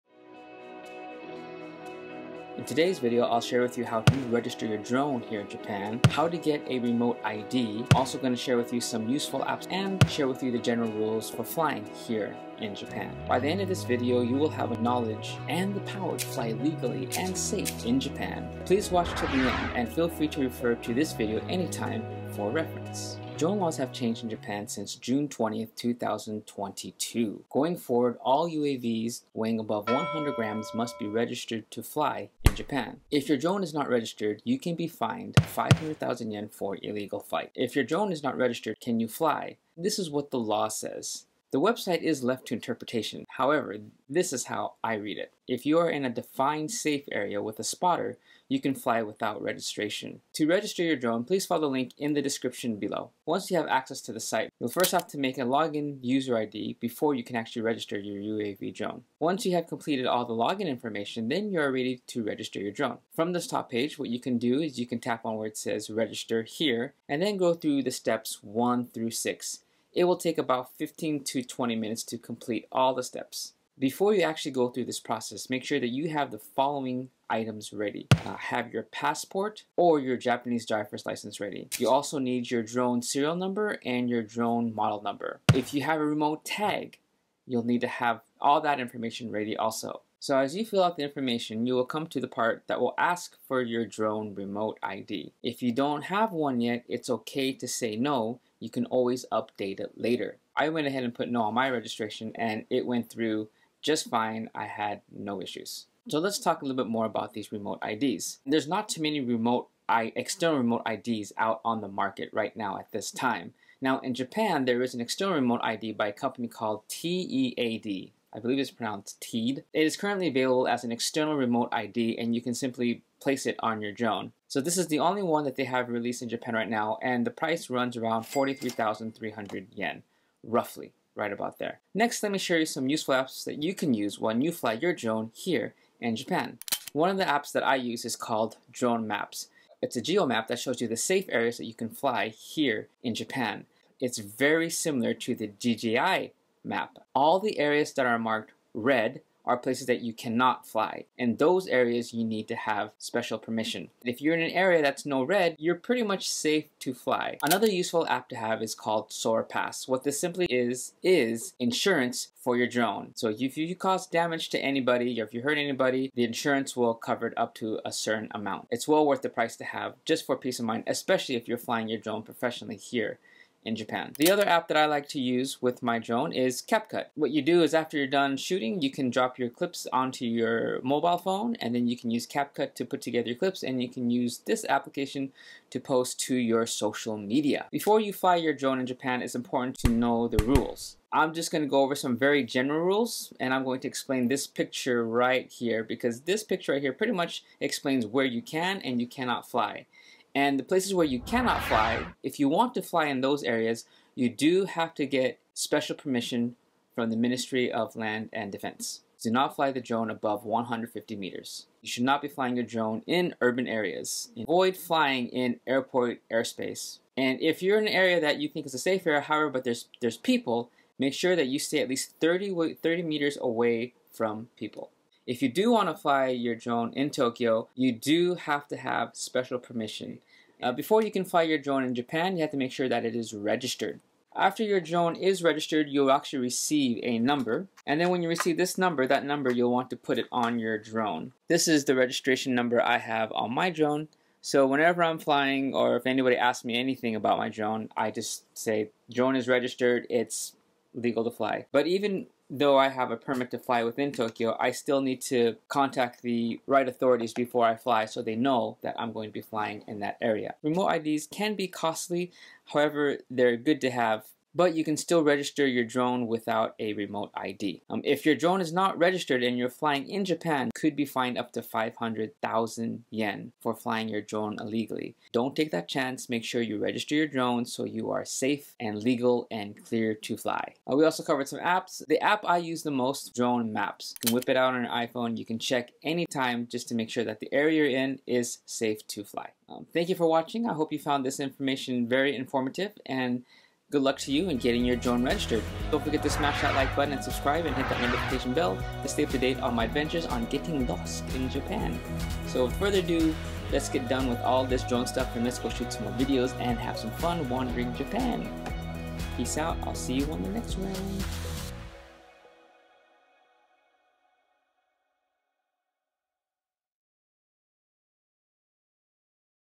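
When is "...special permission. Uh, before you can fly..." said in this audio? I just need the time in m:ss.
3:49.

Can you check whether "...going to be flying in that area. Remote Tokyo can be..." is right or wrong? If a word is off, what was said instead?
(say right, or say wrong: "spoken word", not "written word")
wrong: "IDs", not "Tokyo".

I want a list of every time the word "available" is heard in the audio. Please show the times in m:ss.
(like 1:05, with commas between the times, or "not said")
2:00.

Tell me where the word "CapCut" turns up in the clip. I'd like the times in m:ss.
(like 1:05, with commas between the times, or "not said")
2:56, 3:02.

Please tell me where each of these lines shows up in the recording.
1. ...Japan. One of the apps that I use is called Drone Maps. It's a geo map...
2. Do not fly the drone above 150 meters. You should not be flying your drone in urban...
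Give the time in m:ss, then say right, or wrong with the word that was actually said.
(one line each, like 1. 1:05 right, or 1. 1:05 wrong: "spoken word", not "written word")
1. 2:16 right
2. 3:29 right.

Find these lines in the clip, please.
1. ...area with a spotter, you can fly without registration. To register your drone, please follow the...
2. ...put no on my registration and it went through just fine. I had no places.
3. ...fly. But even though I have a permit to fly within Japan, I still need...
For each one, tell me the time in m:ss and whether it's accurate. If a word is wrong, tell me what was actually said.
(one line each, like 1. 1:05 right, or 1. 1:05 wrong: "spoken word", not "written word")
1. 0:47 right
2. 1:41 wrong: "issues", not "places"
3. 4:11 wrong: "Tokyo", not "Japan".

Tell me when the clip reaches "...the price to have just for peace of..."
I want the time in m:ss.
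2:49.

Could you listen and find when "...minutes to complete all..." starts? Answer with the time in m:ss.
1:11.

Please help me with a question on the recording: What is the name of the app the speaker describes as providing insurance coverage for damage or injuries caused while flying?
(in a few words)
SOAR Pass.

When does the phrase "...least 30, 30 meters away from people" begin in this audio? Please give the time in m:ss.
3:41.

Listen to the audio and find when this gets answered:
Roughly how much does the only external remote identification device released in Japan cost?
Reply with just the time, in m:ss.
2:08.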